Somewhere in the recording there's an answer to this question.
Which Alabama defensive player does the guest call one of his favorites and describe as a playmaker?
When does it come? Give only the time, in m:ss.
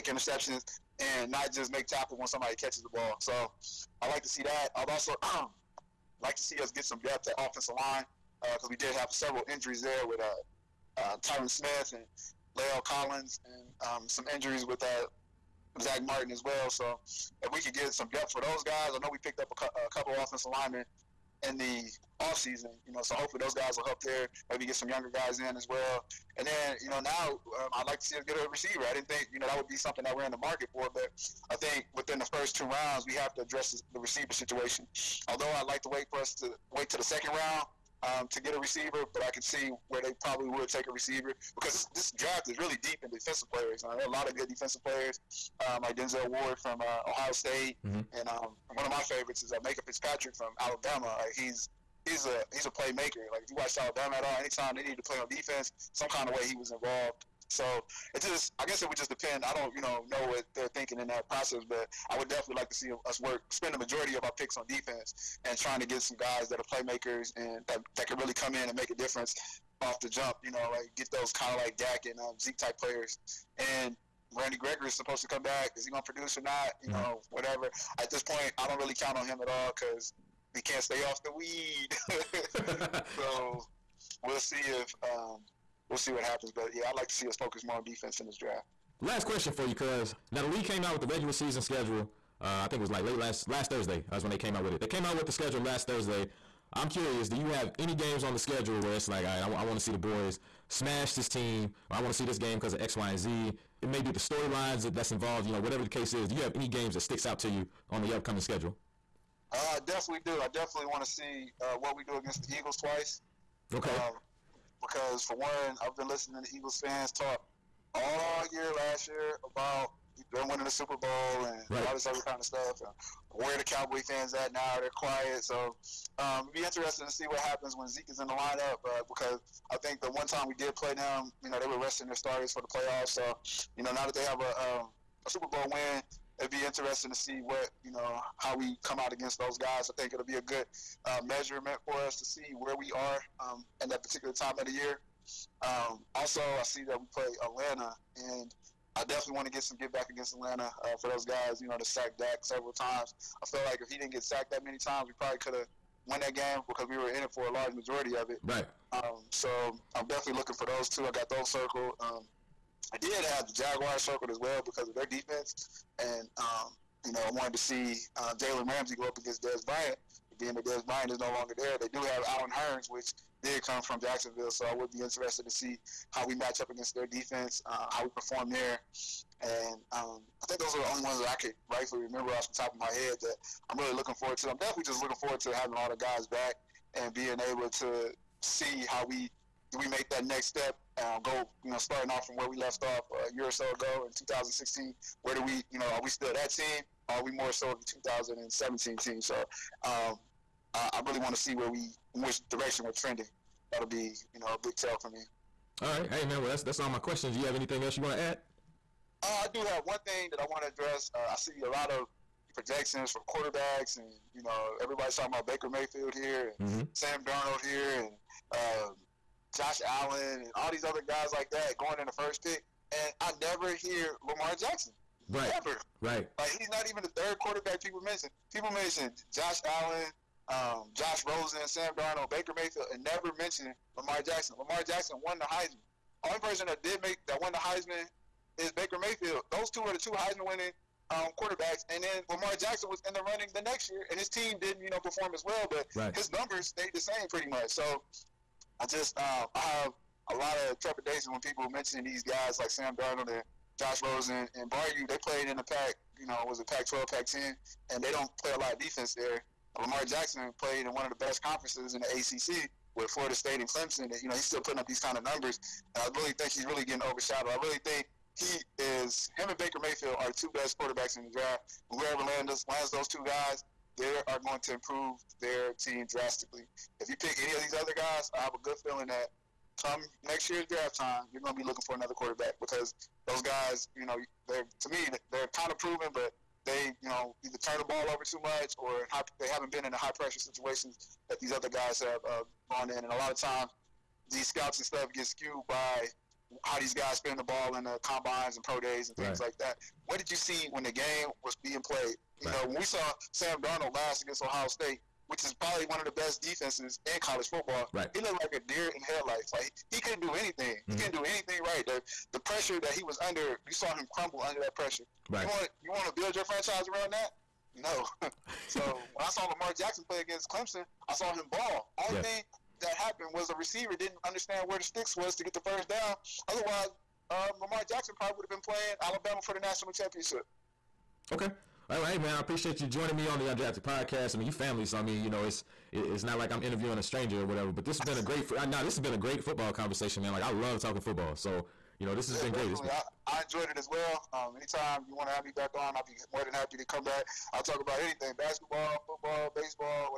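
0:49.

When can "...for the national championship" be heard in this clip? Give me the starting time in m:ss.
5:29.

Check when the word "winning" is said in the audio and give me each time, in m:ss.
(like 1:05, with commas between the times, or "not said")
2:00, 4:00.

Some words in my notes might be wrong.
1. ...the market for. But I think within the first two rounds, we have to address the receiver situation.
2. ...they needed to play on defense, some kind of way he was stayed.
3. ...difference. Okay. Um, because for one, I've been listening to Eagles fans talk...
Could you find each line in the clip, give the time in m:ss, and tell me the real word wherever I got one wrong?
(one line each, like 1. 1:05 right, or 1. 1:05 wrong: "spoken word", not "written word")
1. 0:30 right
2. 0:54 wrong: "involved", not "stayed"
3. 1:52 wrong: "twice", not "difference".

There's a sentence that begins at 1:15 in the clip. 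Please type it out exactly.
Is he going to produce or not?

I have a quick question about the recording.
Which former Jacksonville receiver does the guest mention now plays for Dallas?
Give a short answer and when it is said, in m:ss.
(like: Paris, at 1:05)
Allen Hurns, at 2:52.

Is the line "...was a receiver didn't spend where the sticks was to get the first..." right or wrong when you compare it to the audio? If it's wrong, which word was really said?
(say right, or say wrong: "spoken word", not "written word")
wrong: "understand", not "spend".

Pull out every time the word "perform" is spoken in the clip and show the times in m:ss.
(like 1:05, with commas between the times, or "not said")
2:58, 4:04.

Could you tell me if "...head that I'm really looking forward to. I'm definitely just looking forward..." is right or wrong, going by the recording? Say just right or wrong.
right.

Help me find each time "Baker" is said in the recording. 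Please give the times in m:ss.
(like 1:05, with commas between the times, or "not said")
3:35, 3:52, 3:58, 4:29.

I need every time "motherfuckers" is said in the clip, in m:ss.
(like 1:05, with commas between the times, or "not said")
not said.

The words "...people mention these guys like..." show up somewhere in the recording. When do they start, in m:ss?
4:11.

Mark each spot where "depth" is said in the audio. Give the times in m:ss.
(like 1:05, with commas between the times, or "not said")
0:07, 0:18.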